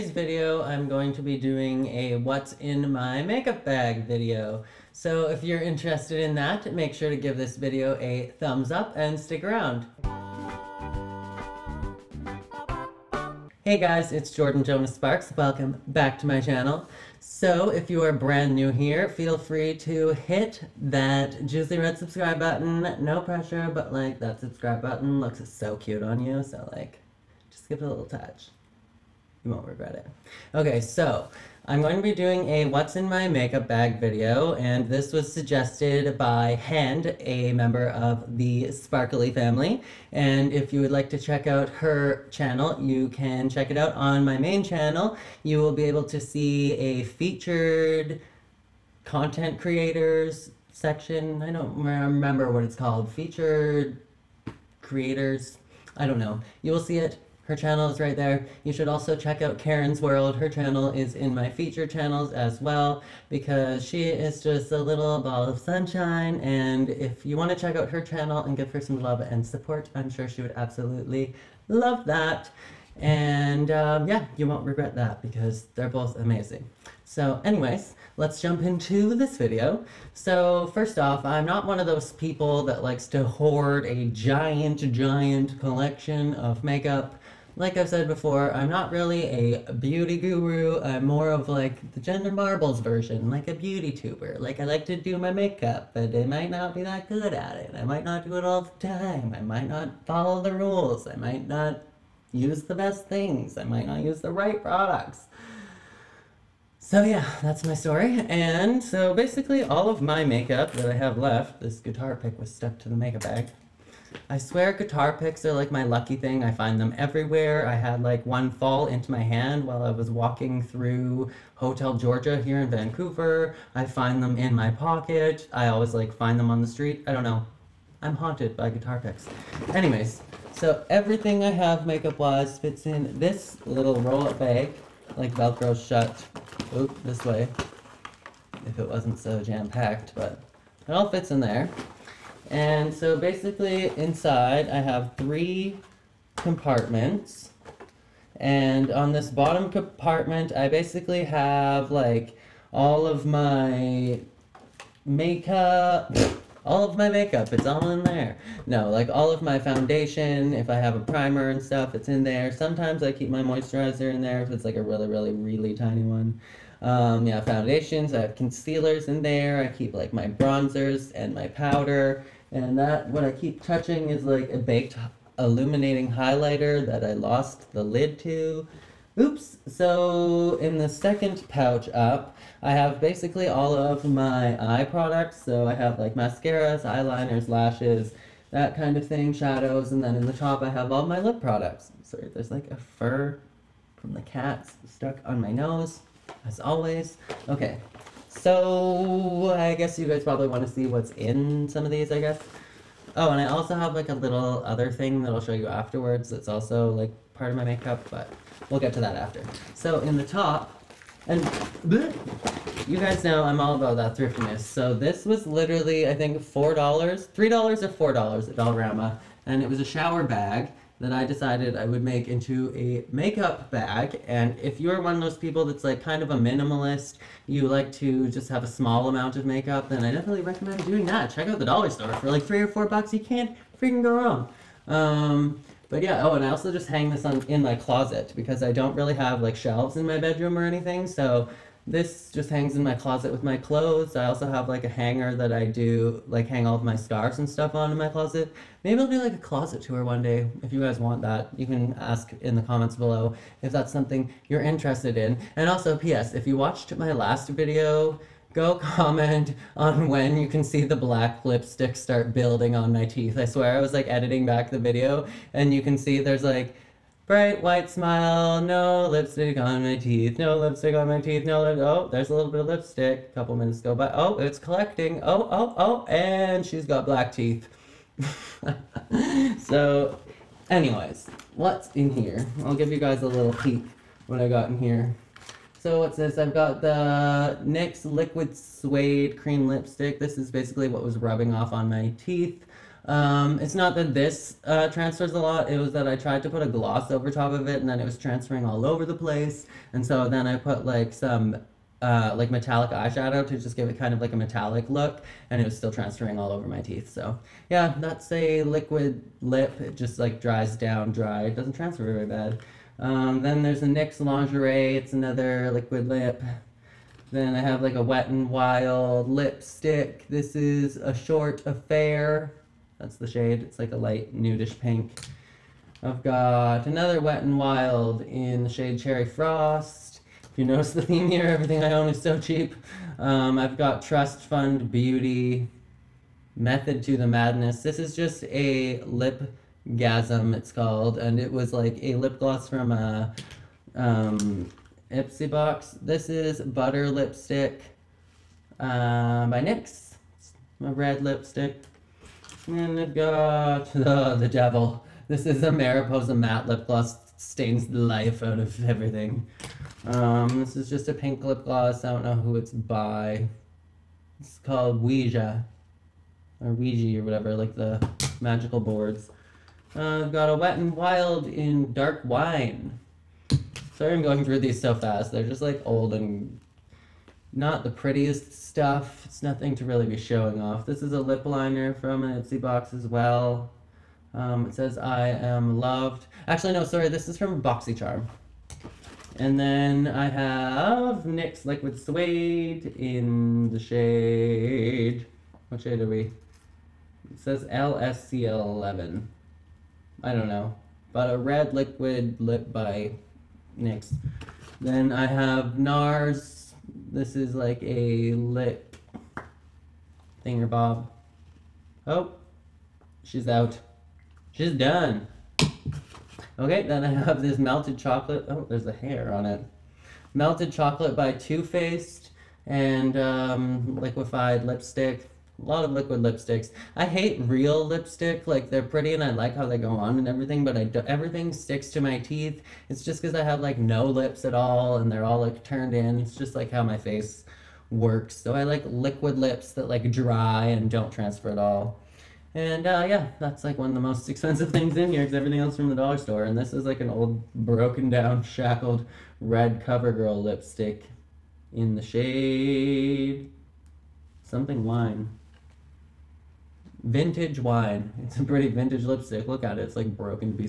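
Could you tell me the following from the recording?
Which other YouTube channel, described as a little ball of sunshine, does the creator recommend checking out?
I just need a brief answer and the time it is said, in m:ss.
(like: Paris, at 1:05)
Karen's World, at 0:59.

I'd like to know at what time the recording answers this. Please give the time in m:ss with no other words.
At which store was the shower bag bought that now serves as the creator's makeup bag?
3:38.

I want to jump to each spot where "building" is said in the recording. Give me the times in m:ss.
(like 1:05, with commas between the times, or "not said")
4:22.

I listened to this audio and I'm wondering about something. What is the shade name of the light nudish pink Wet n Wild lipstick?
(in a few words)
A Short Affair.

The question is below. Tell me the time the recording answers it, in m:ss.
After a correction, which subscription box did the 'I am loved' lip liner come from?
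6:27.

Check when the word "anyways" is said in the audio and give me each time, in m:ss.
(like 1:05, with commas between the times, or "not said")
1:17, 2:09, 4:40.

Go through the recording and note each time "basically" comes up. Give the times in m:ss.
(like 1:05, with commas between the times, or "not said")
1:49, 2:23, 2:30, 3:02, 4:50.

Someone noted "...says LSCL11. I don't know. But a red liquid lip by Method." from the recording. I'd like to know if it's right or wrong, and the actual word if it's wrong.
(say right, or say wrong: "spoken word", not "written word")
wrong: "NYX", not "Method".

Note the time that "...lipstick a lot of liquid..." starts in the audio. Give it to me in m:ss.
7:04.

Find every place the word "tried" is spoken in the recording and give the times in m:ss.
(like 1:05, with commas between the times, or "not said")
4:56.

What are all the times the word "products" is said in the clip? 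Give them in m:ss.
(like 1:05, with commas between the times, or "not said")
1:44, 3:04, 3:11.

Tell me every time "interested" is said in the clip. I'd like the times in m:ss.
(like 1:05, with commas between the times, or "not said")
0:05, 4:14.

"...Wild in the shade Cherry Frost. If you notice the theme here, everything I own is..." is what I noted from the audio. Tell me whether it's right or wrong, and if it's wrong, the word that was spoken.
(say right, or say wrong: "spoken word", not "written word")
right.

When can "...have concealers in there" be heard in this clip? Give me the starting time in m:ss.
2:48.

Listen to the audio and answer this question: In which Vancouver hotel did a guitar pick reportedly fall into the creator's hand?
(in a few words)
Hotel Georgia.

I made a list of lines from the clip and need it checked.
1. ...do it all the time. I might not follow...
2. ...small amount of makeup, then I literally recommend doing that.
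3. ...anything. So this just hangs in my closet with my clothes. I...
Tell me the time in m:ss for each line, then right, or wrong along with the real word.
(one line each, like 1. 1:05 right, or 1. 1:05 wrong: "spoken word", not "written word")
1. 1:38 right
2. 3:48 wrong: "definitely", not "literally"
3. 4:00 right.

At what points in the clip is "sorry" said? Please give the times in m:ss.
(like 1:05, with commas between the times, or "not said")
3:12, 6:13, 6:26.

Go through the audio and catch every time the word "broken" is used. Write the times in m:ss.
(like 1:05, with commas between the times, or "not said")
7:27, 7:40.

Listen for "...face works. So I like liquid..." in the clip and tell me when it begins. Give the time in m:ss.
7:16.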